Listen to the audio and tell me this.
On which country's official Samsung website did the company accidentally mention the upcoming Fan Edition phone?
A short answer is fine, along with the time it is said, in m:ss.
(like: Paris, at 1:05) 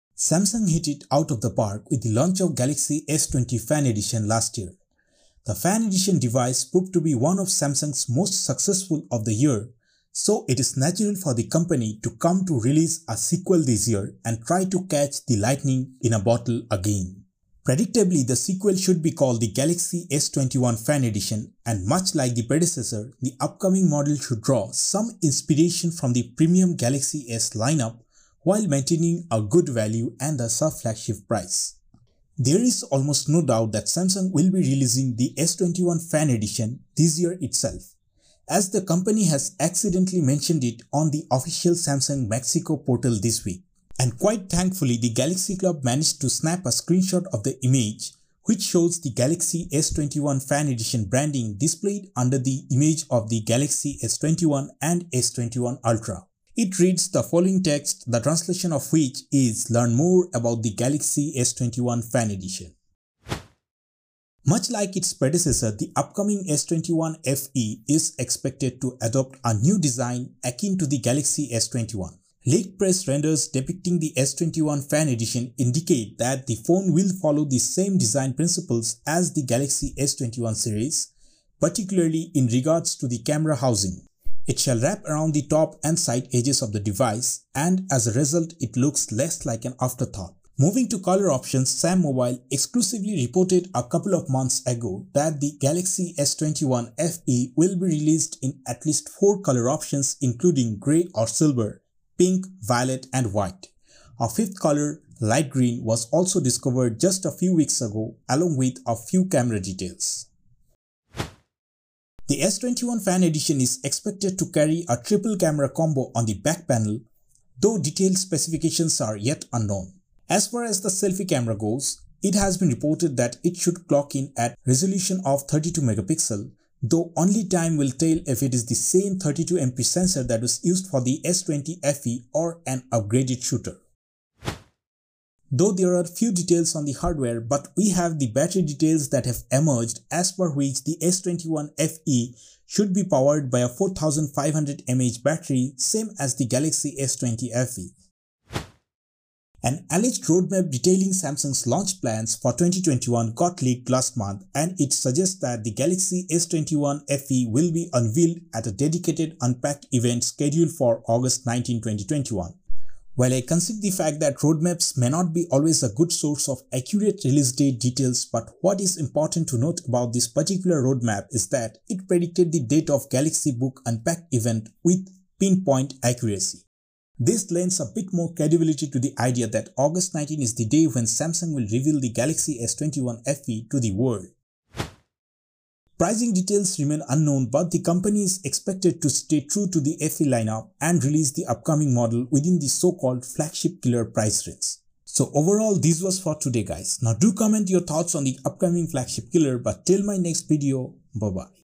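Mexico, at 0:41.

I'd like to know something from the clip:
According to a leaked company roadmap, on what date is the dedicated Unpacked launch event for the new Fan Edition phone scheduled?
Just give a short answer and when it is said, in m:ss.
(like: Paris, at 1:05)
August 19, 2021, at 2:41.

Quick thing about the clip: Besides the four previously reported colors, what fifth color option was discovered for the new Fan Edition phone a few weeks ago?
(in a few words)
light green.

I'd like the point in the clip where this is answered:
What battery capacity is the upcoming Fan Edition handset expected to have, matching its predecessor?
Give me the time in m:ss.
2:23.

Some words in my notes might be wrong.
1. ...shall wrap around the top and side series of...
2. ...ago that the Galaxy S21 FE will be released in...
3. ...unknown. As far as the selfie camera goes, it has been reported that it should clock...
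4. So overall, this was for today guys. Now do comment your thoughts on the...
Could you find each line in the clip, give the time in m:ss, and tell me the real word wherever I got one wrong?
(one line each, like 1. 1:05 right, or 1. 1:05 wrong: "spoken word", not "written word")
1. 1:24 wrong: "edges", not "series"
2. 1:34 right
3. 1:59 right
4. 3:15 right.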